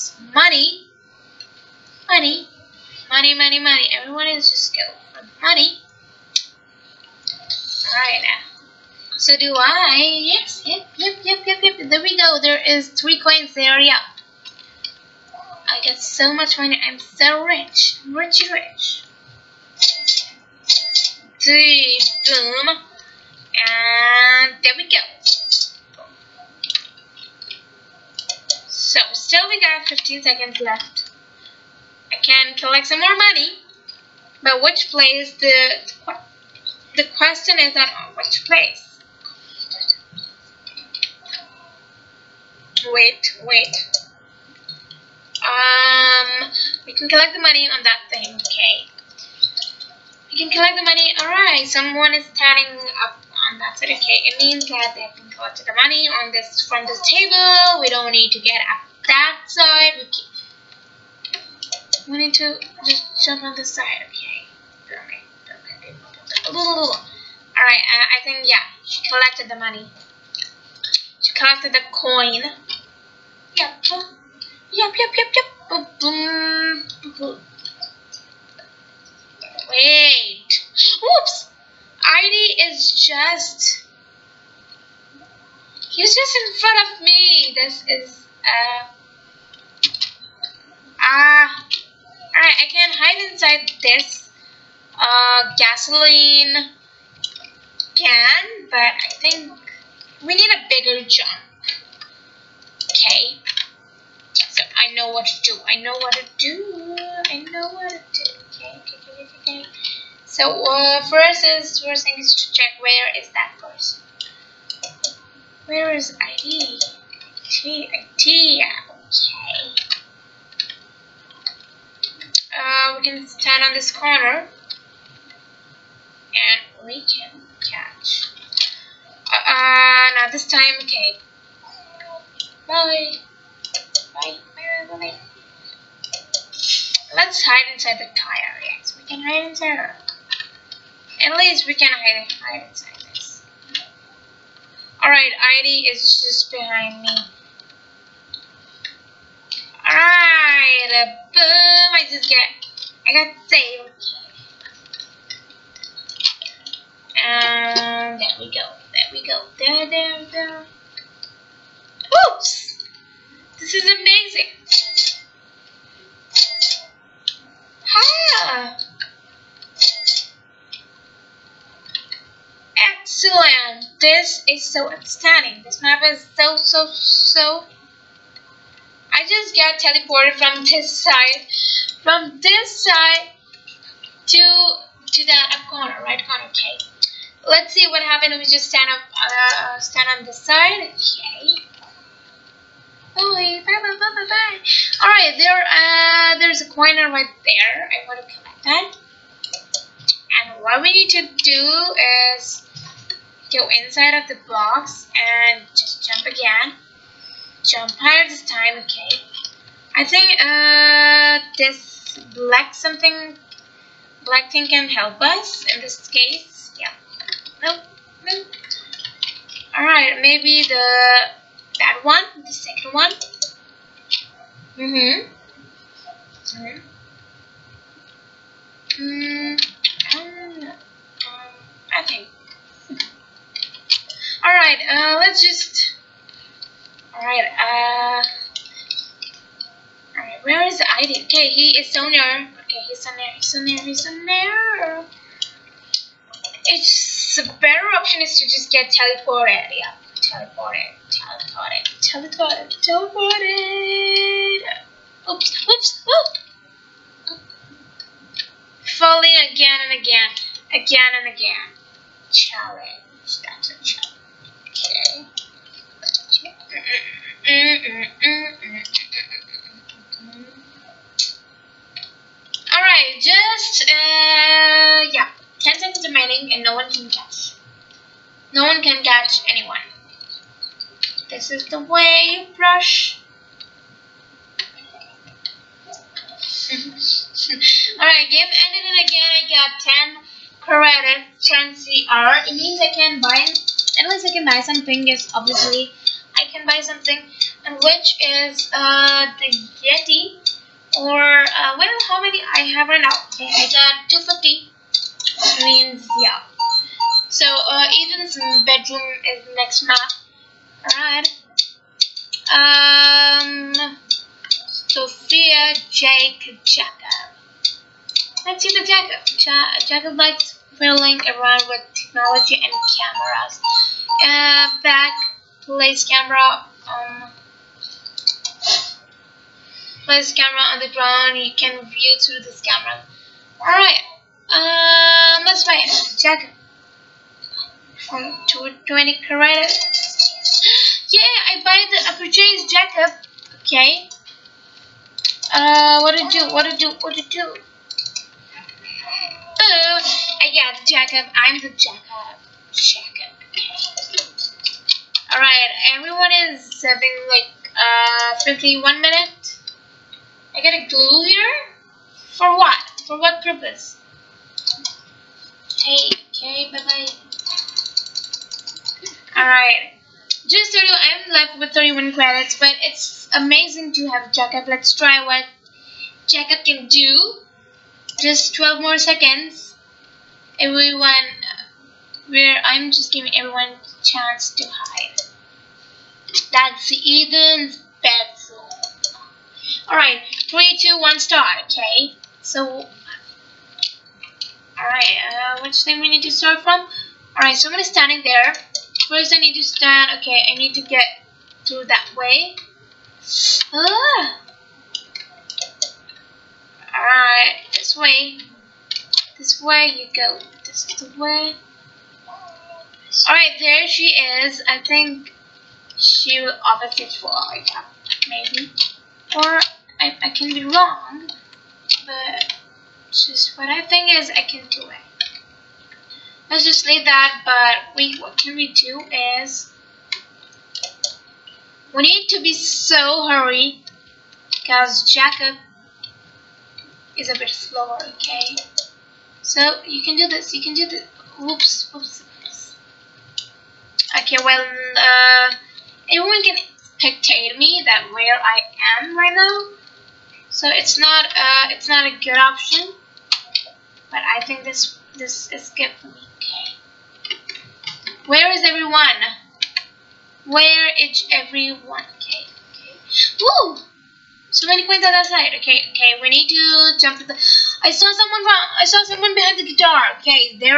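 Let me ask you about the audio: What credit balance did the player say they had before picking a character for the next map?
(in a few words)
250.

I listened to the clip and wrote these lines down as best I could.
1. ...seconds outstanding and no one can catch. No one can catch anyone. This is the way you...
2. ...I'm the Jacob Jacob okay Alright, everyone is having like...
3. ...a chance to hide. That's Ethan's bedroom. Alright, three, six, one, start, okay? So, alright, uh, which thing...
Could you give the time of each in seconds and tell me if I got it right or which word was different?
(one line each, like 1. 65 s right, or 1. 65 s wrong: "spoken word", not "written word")
1. 275 s wrong: "remaining", not "outstanding"
2. 351 s right
3. 383 s wrong: "two", not "six".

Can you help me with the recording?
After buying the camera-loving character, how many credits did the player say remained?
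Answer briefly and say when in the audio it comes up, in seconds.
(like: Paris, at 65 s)
31, at 371 s.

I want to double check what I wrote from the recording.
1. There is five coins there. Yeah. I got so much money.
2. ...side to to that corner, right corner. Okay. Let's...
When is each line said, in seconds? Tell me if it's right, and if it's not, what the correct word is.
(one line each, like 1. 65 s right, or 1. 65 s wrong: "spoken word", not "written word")
1. 12 s wrong: "three", not "five"
2. 182 s right.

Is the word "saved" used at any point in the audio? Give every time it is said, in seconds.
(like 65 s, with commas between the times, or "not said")
153 s.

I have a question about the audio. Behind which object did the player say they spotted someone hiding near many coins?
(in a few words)
the guitar.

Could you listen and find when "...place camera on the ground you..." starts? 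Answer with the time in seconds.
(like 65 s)
330 s.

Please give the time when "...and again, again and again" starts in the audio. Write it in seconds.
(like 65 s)
259 s.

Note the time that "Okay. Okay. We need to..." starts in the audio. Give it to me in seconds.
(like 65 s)
465 s.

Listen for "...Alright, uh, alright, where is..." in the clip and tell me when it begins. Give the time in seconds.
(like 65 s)
237 s.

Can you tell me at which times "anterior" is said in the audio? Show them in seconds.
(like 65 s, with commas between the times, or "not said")
not said.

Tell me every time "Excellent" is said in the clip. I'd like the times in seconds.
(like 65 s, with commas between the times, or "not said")
173 s.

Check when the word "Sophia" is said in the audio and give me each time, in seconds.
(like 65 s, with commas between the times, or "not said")
314 s.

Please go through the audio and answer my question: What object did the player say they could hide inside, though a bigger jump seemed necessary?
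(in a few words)
gasoline can.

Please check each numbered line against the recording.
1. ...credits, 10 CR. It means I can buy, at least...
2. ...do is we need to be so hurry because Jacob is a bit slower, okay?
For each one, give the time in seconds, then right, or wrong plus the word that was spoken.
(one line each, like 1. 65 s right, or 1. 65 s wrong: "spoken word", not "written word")
1. 290 s right
2. 428 s right.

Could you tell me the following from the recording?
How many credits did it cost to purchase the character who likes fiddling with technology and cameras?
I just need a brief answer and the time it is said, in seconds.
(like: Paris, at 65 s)
20, at 338 s.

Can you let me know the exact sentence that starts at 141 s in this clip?
At least we can hide, hide inside this.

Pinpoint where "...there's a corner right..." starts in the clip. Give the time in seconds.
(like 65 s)
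196 s.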